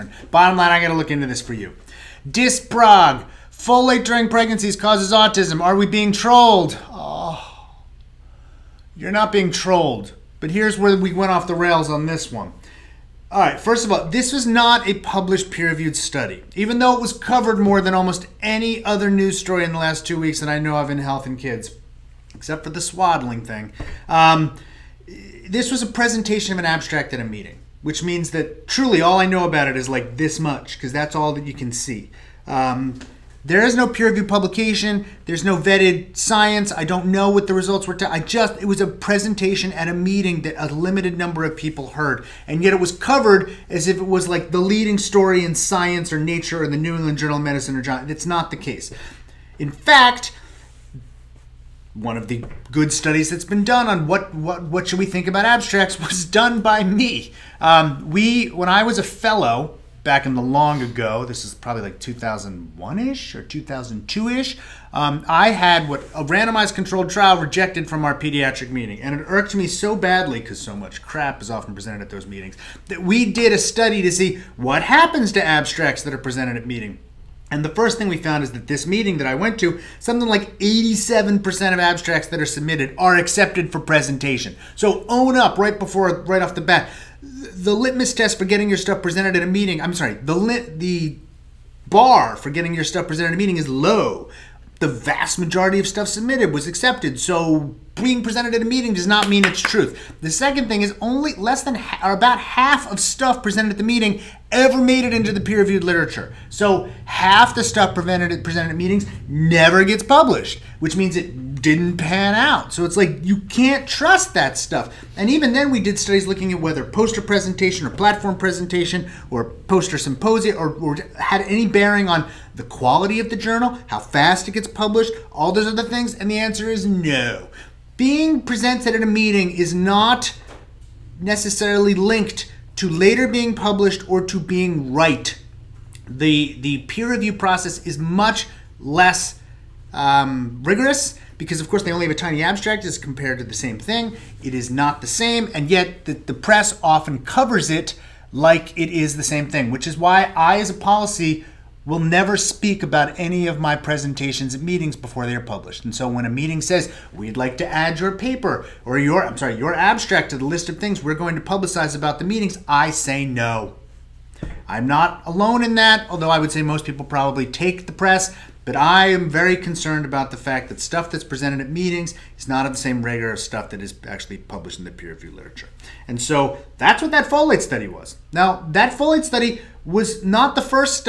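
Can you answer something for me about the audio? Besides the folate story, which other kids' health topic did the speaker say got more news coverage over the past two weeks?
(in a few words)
swaddling.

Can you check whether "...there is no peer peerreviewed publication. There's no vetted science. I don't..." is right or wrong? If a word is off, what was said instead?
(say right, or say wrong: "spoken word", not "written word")
wrong: "reviewed", not "peerreviewed".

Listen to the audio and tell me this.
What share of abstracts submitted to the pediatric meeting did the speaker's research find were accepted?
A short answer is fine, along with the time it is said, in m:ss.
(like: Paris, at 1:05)
87%, at 1:20.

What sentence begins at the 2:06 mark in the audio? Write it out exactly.
And the answer is no being presented at a meeting is not necessarily linked to later being published or to being right.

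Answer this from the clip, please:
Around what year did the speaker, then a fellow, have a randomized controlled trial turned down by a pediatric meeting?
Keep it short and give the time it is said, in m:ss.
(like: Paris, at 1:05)
2001, at 1:01.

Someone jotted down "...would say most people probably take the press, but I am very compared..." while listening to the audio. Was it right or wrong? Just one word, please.
wrong.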